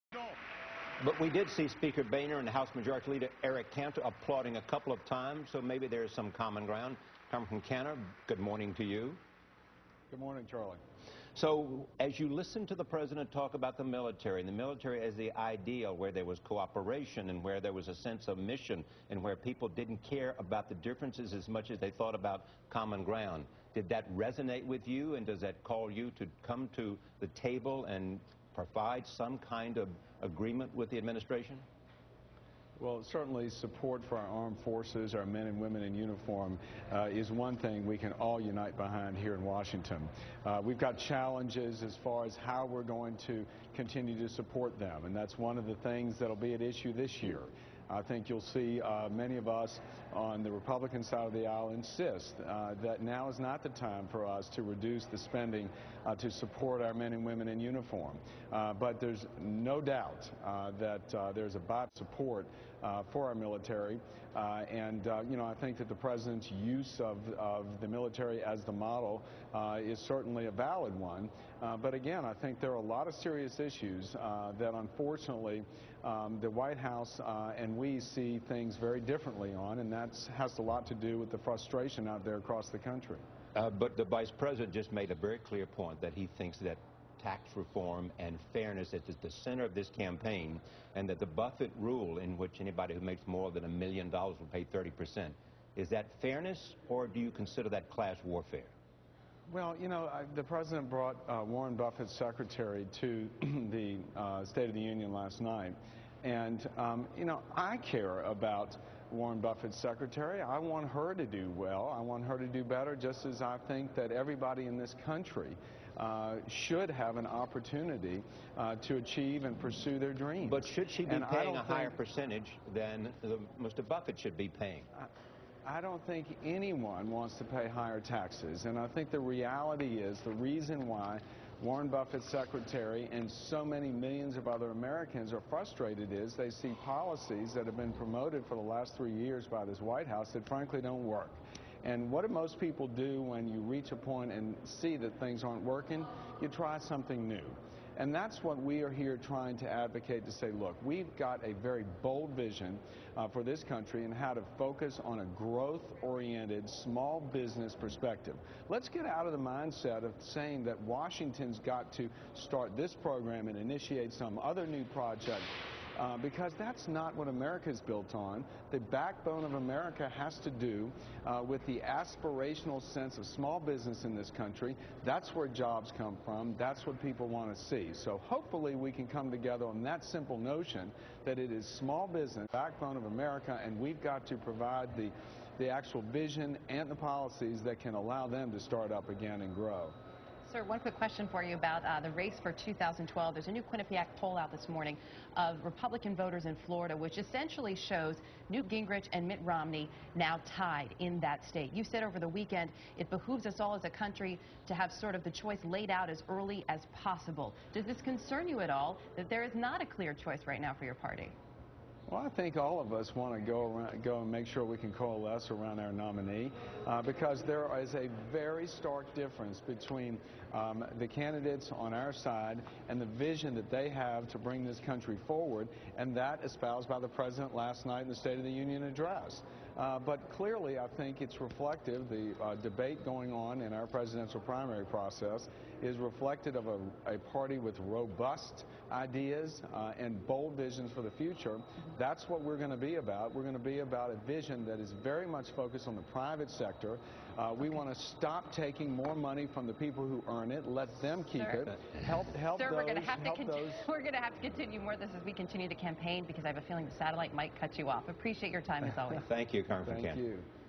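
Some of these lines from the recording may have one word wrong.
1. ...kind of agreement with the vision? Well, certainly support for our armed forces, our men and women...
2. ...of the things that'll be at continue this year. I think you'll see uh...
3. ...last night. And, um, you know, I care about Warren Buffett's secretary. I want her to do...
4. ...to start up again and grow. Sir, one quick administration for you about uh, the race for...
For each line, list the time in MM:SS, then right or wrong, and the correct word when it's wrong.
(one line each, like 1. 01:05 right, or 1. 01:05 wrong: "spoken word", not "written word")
1. 00:29 wrong: "administration", not "vision"
2. 00:45 wrong: "issue", not "continue"
3. 01:45 right
4. 03:08 wrong: "question", not "administration".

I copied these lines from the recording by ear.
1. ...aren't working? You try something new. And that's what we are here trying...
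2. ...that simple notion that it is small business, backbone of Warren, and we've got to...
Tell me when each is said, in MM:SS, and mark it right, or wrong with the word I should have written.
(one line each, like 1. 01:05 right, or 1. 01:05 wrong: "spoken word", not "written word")
1. 02:25 right
2. 02:59 wrong: "America", not "Warren".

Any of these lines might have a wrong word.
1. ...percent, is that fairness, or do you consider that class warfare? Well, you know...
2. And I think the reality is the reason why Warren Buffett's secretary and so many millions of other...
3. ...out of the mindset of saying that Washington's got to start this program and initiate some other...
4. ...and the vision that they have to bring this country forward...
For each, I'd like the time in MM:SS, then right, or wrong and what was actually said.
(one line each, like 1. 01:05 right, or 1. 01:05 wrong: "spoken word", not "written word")
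1. 01:34 right
2. 02:08 right
3. 02:39 right
4. 03:42 right.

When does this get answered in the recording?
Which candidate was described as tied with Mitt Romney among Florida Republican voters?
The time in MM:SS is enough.
03:18.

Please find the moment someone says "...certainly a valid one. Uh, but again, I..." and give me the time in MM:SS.
01:09.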